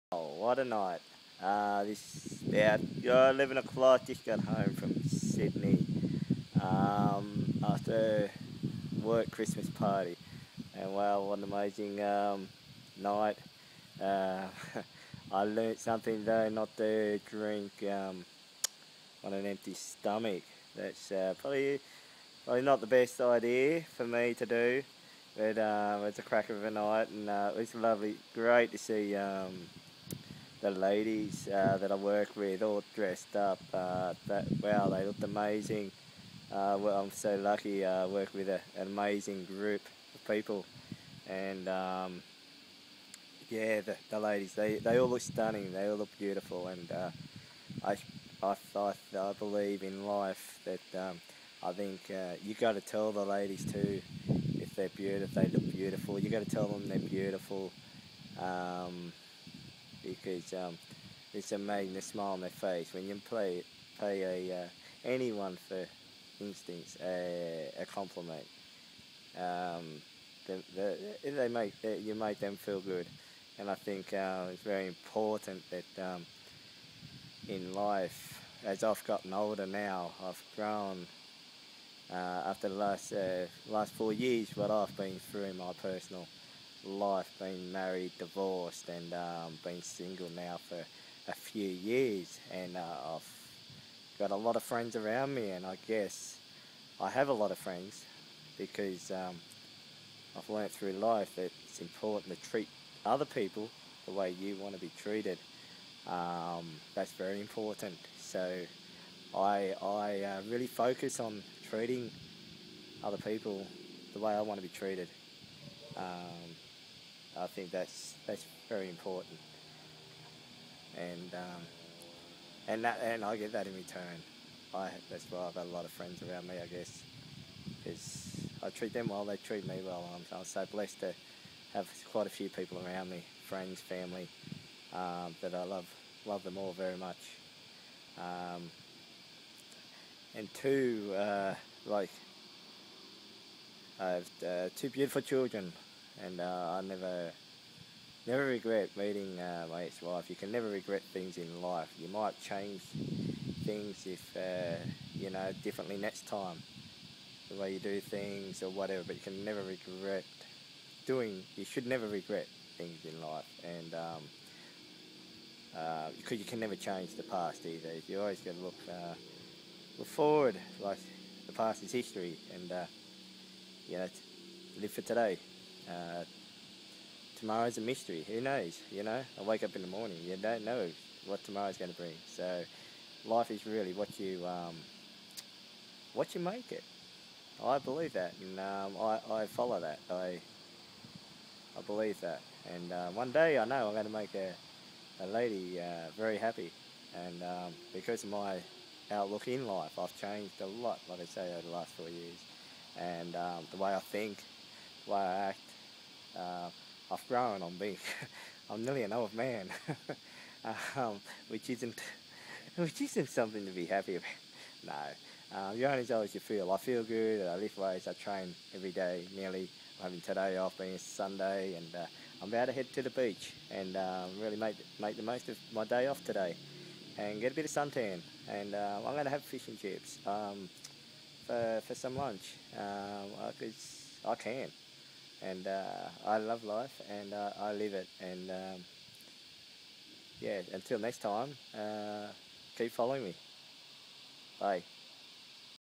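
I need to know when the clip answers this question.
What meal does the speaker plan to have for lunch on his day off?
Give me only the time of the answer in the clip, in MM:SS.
03:49.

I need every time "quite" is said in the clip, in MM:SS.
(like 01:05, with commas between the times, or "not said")
00:00, 02:12.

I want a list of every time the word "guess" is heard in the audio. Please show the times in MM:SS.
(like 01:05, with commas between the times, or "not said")
01:35, 02:06.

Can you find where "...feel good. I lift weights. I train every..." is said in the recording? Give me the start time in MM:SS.
03:36.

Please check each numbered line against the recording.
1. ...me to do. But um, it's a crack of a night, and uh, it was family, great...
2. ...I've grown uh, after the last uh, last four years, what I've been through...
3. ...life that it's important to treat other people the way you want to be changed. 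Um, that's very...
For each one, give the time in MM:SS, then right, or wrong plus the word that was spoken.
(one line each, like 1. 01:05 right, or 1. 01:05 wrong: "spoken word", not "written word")
1. 00:24 wrong: "lovely", not "family"
2. 01:20 right
3. 01:40 wrong: "treated", not "changed".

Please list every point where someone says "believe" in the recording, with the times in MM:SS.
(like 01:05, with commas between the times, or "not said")
00:49, 03:07, 03:11.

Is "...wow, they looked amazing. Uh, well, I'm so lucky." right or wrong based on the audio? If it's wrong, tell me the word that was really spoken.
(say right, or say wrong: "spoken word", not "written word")
right.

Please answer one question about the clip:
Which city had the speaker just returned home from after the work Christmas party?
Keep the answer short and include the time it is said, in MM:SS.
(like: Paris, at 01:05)
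Sydney, at 00:05.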